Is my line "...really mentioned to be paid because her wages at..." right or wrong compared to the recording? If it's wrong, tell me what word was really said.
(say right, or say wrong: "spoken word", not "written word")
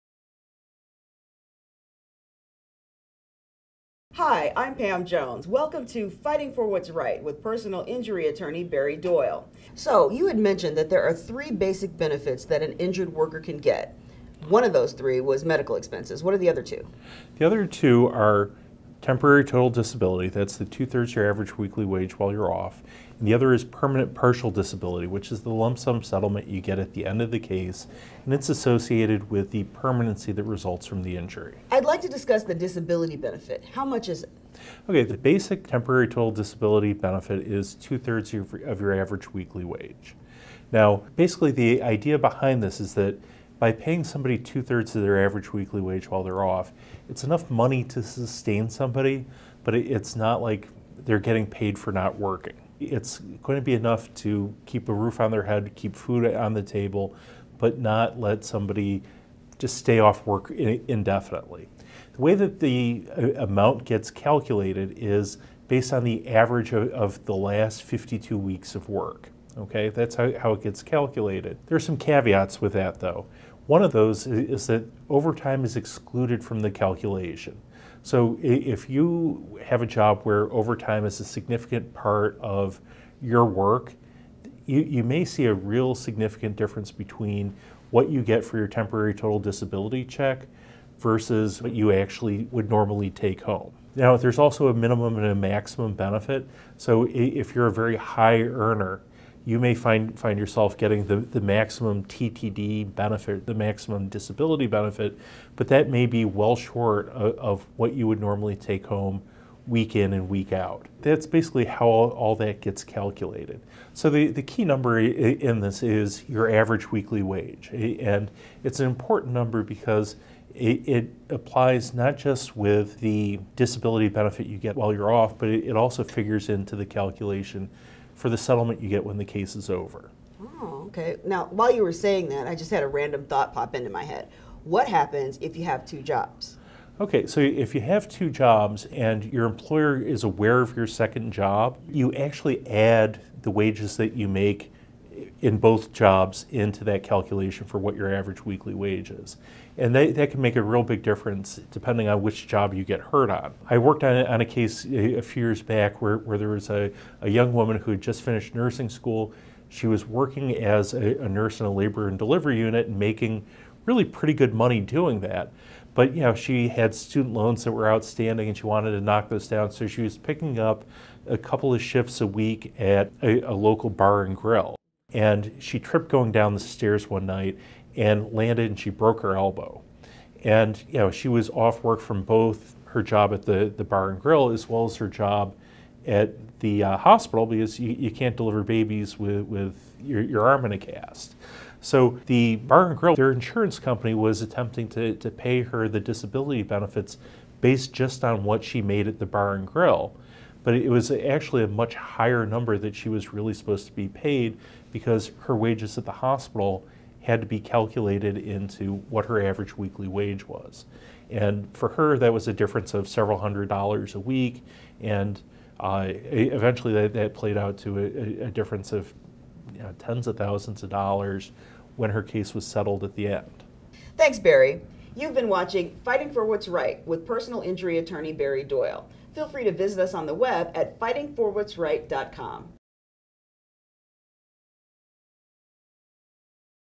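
wrong: "supposed", not "mentioned".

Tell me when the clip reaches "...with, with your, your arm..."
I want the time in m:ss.
3:09.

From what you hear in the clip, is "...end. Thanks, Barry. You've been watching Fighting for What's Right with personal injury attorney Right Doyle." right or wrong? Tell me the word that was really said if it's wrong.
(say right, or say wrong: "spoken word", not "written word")
wrong: "Barry", not "Right".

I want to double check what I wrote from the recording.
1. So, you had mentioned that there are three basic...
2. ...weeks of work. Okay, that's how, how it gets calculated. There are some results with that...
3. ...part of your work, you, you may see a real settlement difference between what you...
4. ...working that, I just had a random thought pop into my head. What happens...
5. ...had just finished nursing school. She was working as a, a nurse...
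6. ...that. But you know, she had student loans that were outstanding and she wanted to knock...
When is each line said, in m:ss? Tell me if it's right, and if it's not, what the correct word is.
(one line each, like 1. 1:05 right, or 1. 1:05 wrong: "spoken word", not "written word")
1. 0:09 right
2. 1:08 wrong: "caveats", not "results"
3. 1:21 wrong: "significant", not "settlement"
4. 2:11 wrong: "saying", not "working"
5. 2:37 right
6. 2:45 right.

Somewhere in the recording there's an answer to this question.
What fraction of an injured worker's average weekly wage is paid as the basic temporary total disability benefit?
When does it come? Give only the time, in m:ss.
0:20.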